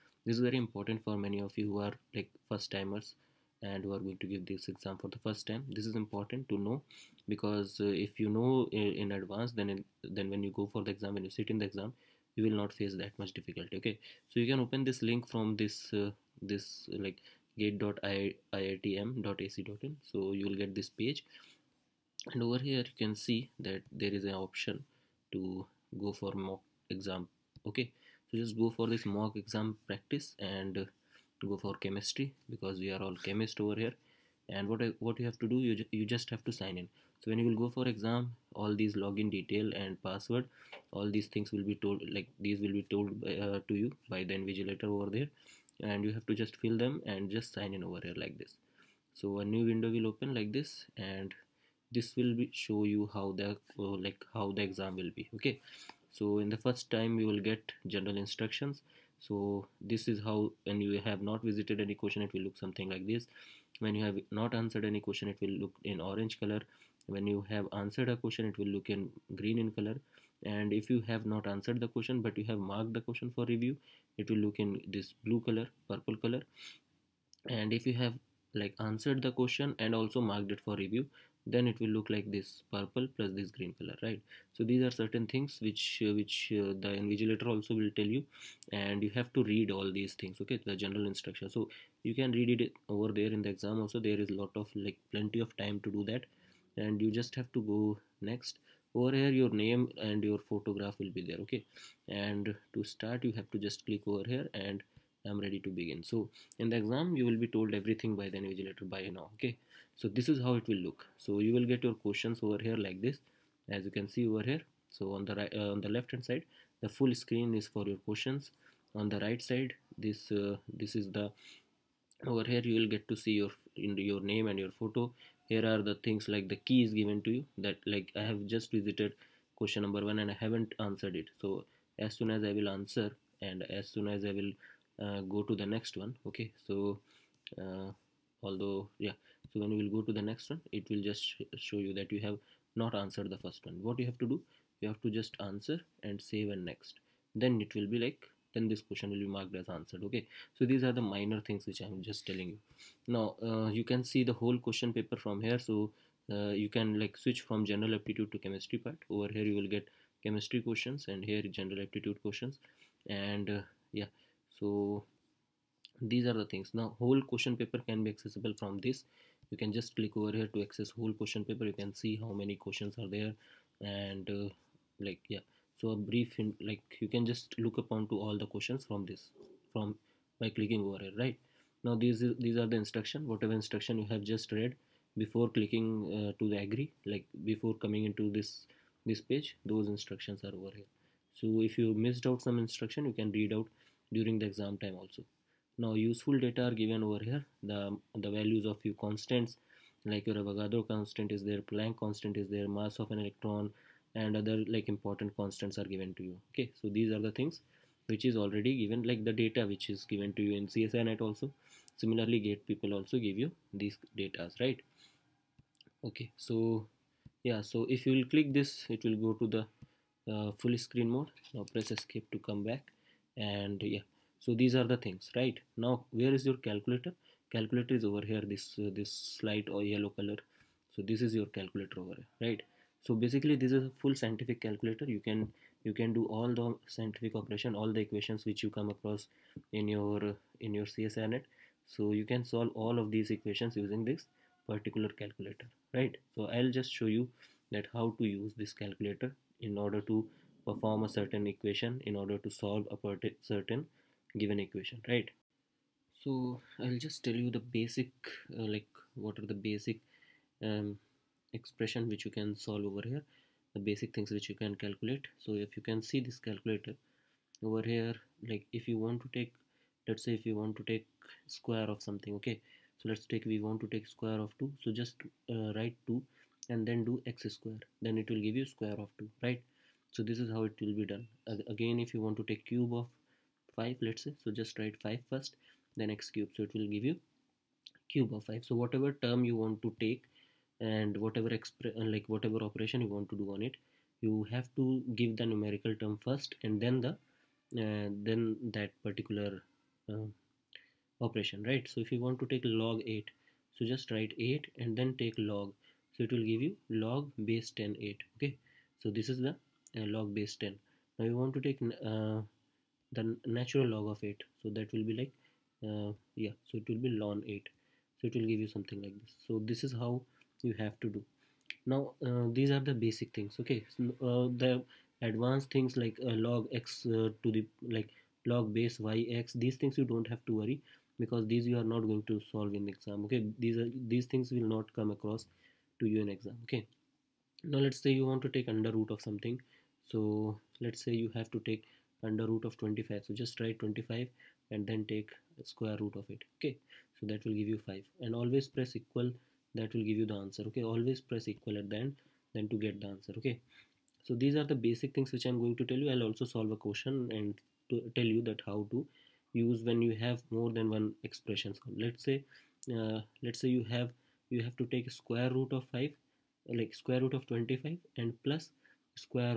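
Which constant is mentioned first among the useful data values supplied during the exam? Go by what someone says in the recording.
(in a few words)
Avogadro constant.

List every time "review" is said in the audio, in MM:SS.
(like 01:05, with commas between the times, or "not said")
01:13, 01:20.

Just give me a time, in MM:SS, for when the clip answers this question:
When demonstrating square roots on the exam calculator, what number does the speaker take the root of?
05:42.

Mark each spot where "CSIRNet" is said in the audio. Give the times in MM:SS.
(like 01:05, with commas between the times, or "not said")
03:30, 04:00.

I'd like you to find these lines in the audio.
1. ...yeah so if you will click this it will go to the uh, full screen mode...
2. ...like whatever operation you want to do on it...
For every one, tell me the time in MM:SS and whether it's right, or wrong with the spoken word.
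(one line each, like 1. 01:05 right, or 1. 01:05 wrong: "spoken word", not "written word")
1. 03:37 right
2. 04:52 right.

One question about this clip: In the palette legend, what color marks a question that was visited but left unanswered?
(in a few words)
Orange.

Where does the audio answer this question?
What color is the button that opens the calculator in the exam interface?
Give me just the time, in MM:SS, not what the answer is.
03:49.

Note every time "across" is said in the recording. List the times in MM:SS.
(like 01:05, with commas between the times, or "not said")
03:58, 05:35.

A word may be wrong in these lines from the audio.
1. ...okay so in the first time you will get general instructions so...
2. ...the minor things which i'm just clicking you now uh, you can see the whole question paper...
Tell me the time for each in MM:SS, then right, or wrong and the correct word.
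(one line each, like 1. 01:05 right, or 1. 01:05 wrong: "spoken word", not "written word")
1. 00:55 right
2. 02:30 wrong: "telling", not "clicking".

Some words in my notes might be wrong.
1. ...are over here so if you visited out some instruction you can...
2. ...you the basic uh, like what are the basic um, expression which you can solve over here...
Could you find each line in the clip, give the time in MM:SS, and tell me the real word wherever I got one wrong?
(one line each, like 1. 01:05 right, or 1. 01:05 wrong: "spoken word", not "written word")
1. 03:10 wrong: "missed", not "visited"
2. 04:17 right.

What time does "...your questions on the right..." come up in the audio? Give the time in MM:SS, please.
01:57.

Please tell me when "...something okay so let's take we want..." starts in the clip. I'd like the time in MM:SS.
04:32.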